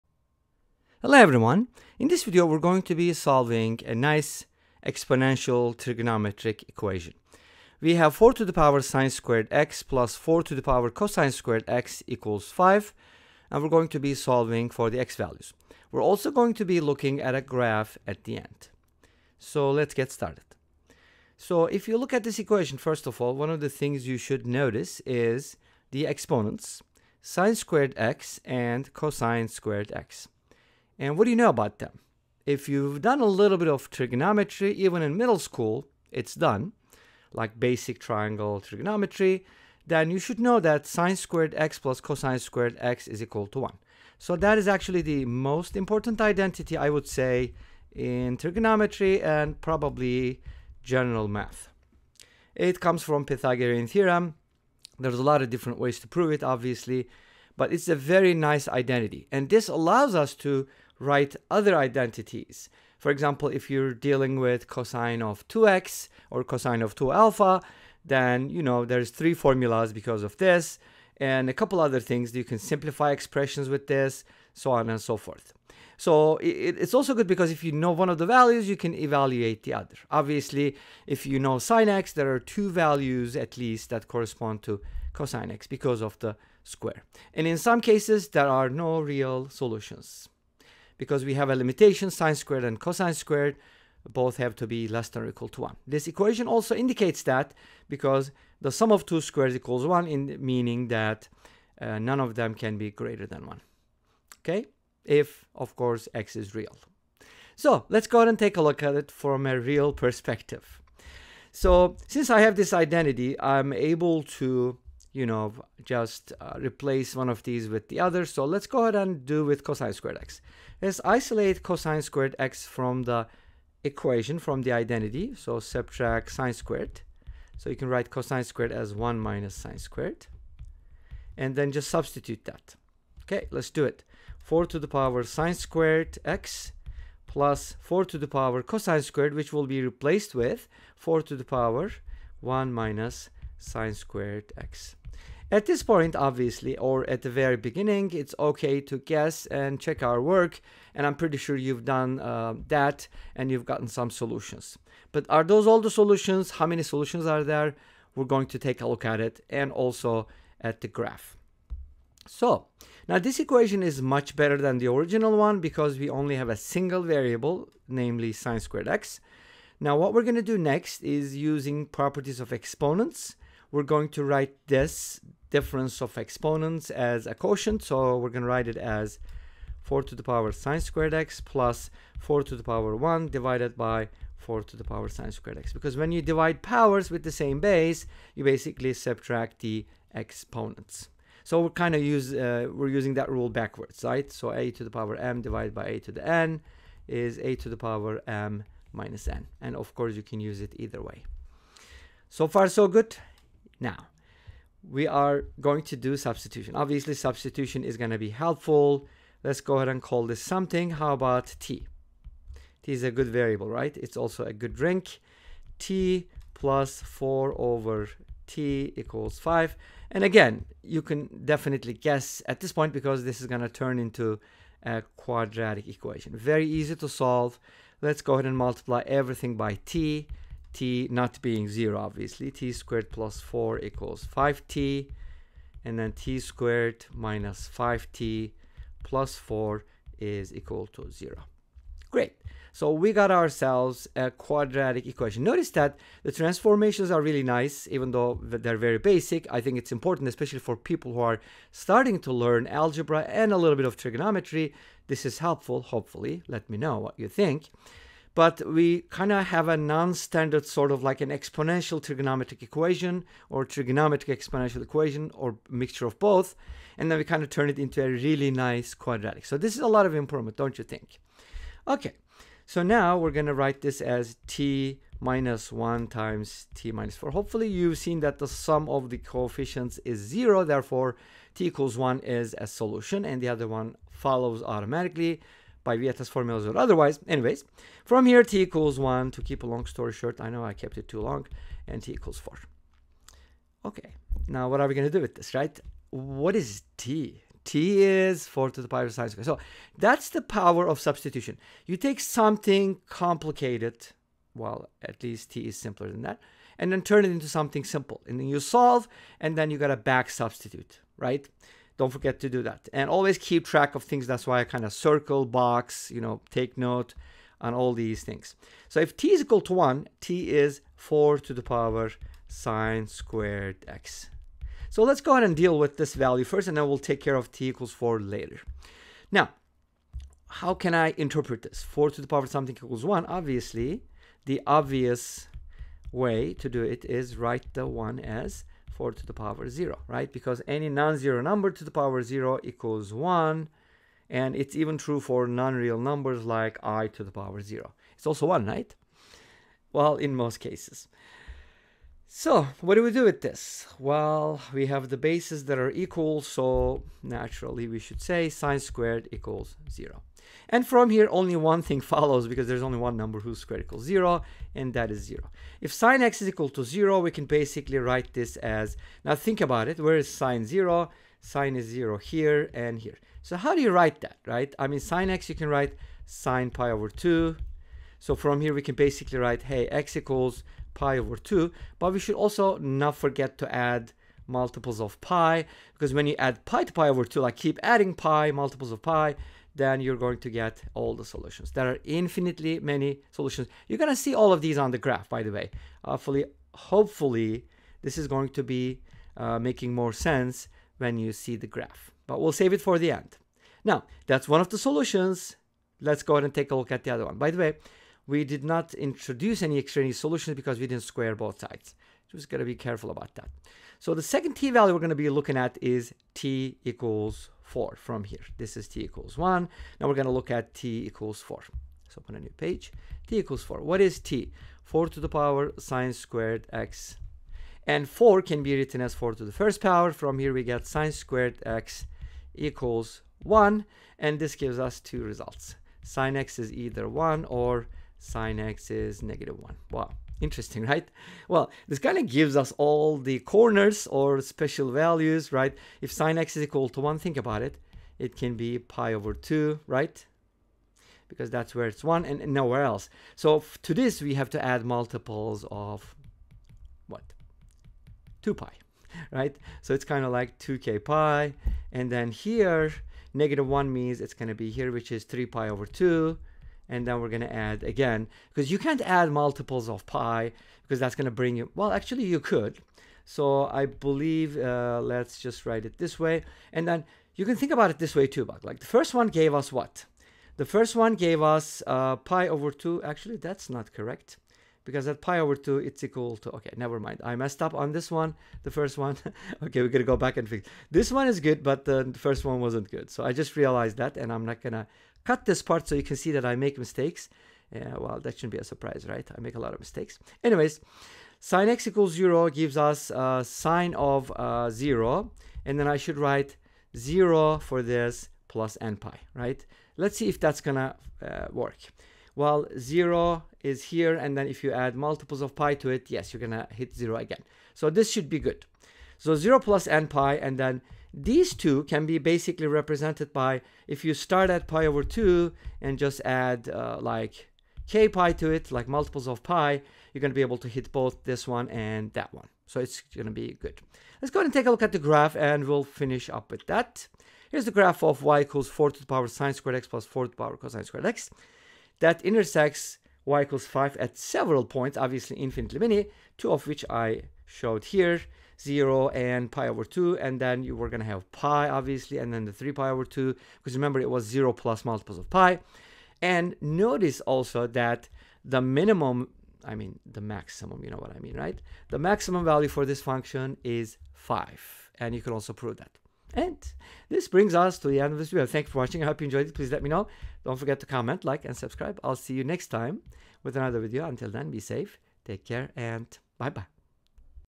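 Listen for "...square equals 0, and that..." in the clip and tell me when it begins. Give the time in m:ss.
6:03.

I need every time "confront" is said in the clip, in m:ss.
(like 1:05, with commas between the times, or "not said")
not said.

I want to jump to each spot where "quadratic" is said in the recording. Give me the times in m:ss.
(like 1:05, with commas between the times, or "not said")
3:45, 4:04, 4:28.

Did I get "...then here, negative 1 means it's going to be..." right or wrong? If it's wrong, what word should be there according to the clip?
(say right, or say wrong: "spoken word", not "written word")
right.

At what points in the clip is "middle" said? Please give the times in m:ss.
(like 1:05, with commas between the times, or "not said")
0:35.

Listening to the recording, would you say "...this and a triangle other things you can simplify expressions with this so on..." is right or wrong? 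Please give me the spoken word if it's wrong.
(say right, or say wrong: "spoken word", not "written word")
wrong: "couple", not "triangle".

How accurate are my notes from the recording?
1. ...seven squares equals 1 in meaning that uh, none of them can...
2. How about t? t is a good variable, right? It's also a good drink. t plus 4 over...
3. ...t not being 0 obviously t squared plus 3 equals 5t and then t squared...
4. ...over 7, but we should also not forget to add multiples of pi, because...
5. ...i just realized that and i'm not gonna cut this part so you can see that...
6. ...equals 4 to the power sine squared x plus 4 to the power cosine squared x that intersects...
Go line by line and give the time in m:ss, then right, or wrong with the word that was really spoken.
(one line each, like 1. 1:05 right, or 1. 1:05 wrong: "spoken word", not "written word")
1. 1:39 wrong: "two", not "seven"
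2. 3:30 right
3. 3:50 wrong: "4", not "3"
4. 6:21 wrong: "2", not "7"
5. 8:13 right
6. 8:58 right.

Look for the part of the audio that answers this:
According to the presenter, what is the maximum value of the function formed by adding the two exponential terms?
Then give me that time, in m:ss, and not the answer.
9:21.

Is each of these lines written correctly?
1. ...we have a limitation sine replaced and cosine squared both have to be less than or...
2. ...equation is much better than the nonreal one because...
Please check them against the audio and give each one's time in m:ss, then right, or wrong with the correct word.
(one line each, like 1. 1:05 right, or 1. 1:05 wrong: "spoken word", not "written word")
1. 1:31 wrong: "squared", not "replaced"
2. 2:43 wrong: "original", not "nonreal".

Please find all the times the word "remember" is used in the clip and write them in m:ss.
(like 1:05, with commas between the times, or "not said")
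9:13.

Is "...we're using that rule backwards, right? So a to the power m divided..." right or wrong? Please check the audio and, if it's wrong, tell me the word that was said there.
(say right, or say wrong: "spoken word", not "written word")
right.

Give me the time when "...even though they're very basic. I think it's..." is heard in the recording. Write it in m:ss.
4:07.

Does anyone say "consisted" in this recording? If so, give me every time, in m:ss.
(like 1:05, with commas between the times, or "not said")
not said.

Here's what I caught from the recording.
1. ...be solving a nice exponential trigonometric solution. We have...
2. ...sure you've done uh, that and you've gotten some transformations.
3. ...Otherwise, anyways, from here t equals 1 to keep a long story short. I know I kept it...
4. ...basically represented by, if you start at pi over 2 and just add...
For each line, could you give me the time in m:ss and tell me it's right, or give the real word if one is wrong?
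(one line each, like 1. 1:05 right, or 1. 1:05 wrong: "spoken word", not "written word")
1. 0:02 wrong: "equation", not "solution"
2. 2:31 wrong: "solutions", not "transformations"
3. 4:46 right
4. 8:42 right.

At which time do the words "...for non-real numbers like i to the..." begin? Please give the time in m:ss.
5:45.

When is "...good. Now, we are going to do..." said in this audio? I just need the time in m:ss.
3:22.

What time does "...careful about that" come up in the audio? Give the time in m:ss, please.
6:52.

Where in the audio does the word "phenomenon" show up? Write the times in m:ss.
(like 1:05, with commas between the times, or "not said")
not said.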